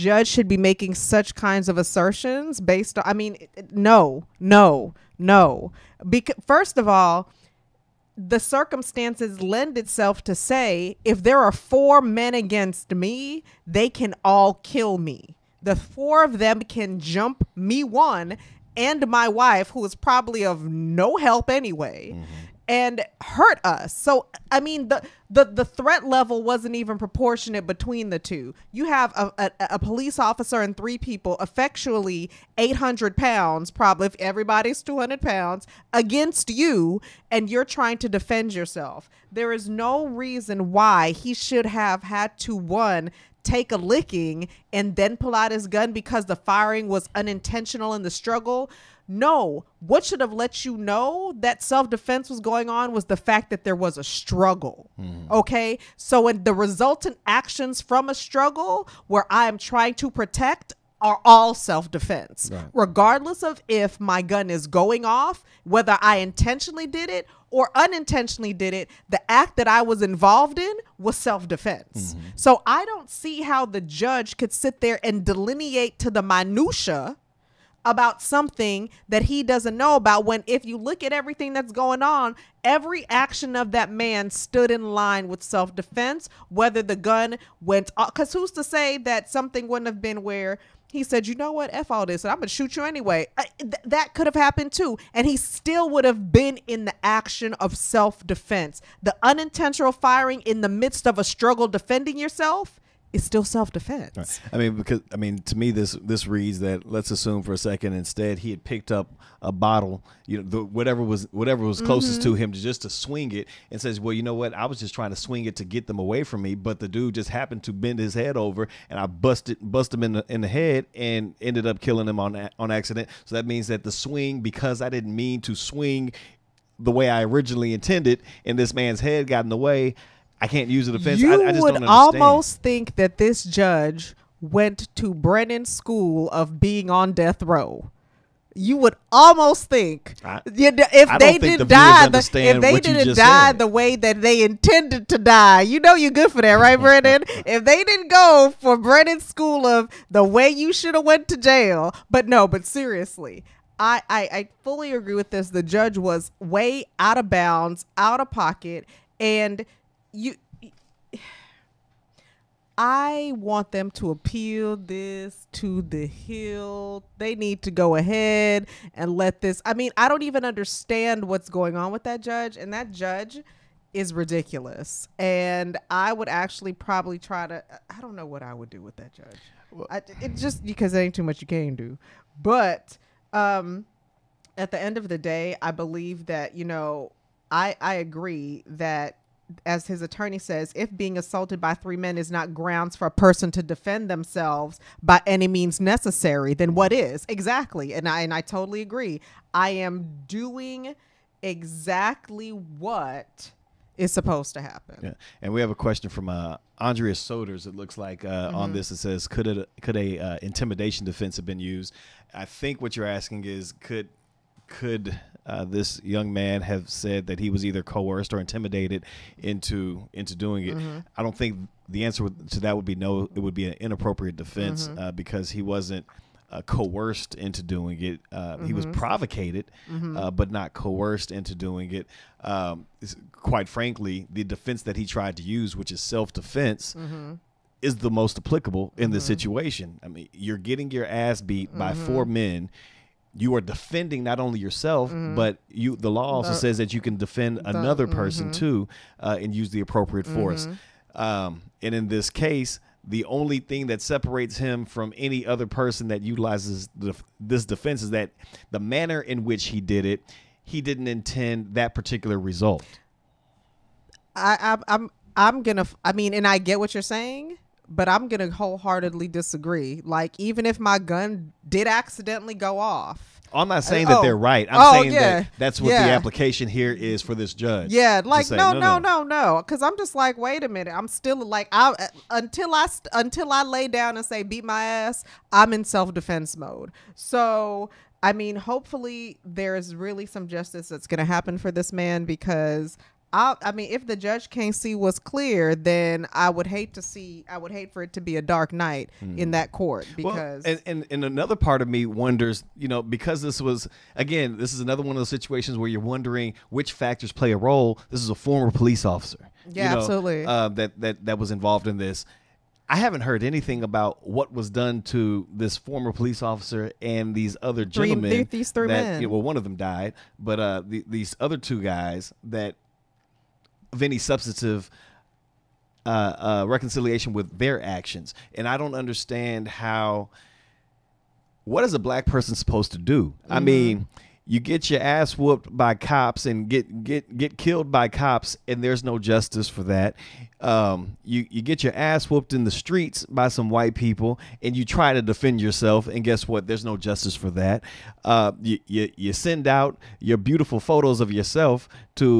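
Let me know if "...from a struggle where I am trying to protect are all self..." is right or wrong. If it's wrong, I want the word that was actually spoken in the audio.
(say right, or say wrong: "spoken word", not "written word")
right.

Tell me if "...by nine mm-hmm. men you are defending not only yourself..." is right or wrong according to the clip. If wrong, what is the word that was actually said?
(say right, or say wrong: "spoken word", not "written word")
wrong: "four", not "nine".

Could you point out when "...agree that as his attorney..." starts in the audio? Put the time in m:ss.
3:07.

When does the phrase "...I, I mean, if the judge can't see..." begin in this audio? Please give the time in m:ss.
4:53.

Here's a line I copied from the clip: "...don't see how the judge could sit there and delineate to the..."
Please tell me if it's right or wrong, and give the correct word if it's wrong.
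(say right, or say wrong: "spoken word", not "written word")
right.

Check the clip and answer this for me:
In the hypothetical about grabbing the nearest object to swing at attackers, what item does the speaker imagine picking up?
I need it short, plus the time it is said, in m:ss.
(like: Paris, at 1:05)
a bottle, at 1:49.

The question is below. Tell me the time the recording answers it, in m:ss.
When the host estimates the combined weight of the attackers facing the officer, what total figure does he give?
0:32.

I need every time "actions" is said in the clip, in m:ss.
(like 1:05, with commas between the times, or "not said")
0:57, 1:23, 1:37, 5:27.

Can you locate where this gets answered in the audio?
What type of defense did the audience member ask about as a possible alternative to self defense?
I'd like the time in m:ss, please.
3:30.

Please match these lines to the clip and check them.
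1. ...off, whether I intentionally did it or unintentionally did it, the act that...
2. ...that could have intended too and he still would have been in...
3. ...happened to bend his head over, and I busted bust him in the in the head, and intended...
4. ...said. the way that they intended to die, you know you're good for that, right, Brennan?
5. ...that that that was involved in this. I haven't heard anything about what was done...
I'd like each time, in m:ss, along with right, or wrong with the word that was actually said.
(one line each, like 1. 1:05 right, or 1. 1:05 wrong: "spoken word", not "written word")
1. 1:05 right
2. 1:33 wrong: "happened", not "intended"
3. 1:57 wrong: "ended", not "intended"
4. 2:23 right
5. 5:10 right.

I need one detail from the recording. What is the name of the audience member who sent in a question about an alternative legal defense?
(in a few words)
Andrea Soders.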